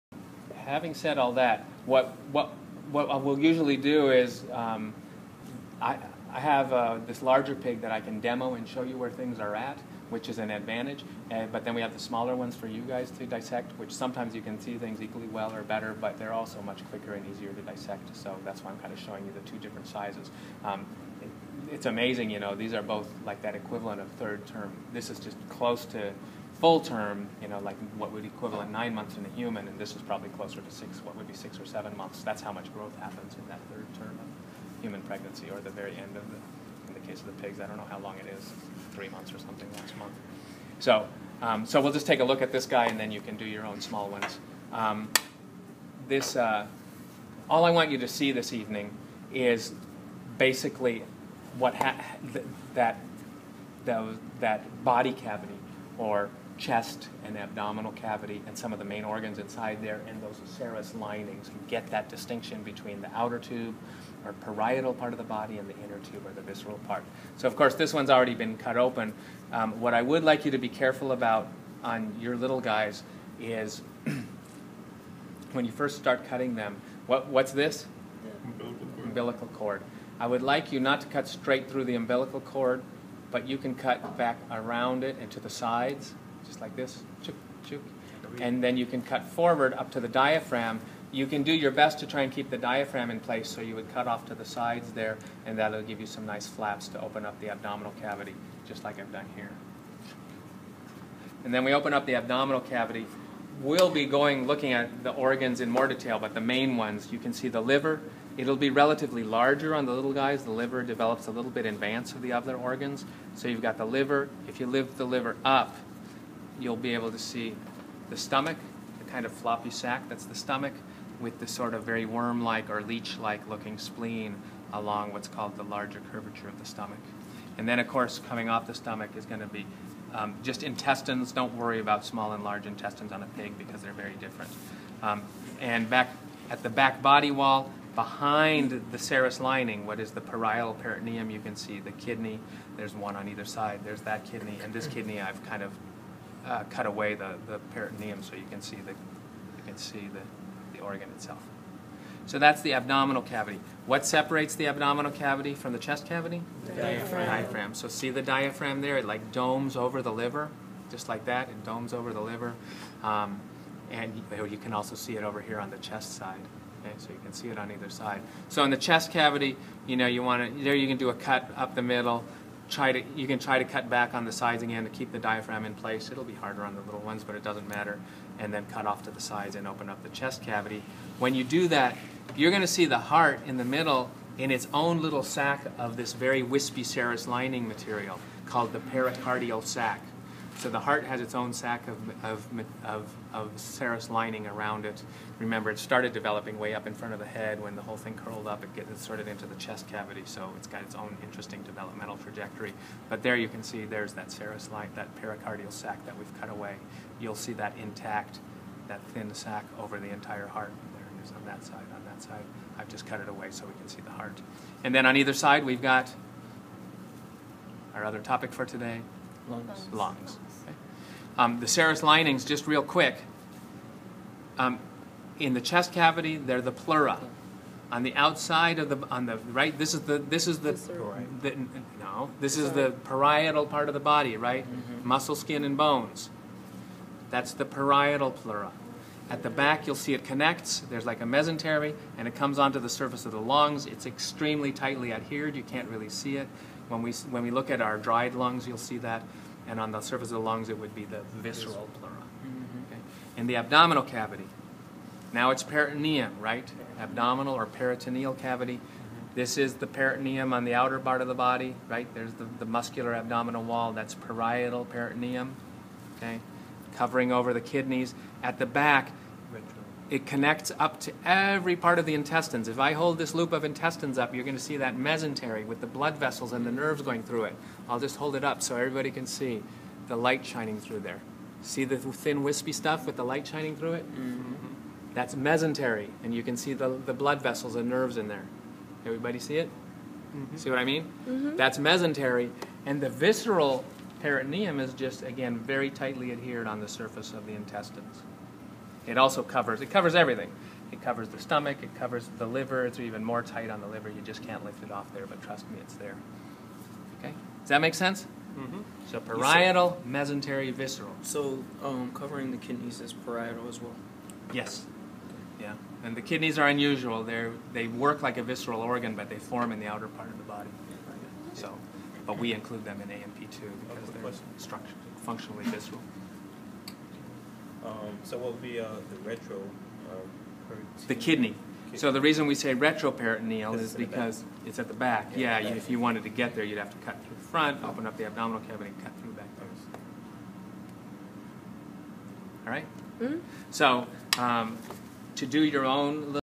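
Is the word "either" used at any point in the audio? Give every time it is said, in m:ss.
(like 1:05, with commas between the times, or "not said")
2:23, 2:47, 3:35.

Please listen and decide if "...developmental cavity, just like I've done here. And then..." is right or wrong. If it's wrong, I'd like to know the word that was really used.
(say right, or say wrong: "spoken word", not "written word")
wrong: "abdominal", not "developmental".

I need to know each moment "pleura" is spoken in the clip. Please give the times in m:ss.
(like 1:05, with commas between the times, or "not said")
3:46, 3:58, 4:11.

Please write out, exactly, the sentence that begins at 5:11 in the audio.
So um, covering the kidneys is parietal as well.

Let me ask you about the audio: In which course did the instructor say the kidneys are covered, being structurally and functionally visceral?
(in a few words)
A&P2.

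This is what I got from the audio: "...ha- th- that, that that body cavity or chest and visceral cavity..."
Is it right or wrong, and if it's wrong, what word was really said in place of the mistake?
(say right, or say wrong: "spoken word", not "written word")
wrong: "abdominal", not "visceral".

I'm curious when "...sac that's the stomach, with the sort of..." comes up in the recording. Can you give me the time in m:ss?
1:59.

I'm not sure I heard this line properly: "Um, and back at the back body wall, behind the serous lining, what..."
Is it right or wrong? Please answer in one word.
right.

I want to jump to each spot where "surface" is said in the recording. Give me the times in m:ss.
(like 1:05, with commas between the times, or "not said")
4:02, 4:10, 4:56.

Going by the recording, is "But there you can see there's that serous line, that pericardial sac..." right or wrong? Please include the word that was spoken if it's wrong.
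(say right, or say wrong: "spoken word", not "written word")
right.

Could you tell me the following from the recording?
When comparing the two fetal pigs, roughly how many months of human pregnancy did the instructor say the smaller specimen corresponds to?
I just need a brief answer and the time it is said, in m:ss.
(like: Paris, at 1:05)
6 or 7 months, at 0:31.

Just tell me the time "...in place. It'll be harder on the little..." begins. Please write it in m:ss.
2:55.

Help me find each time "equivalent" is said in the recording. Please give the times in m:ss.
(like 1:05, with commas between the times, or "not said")
0:23, 0:28.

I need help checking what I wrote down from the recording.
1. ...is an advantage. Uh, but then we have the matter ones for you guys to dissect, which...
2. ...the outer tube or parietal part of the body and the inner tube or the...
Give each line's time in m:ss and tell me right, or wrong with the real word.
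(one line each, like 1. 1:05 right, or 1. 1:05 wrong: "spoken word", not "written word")
1. 0:10 wrong: "smaller", not "matter"
2. 1:03 right.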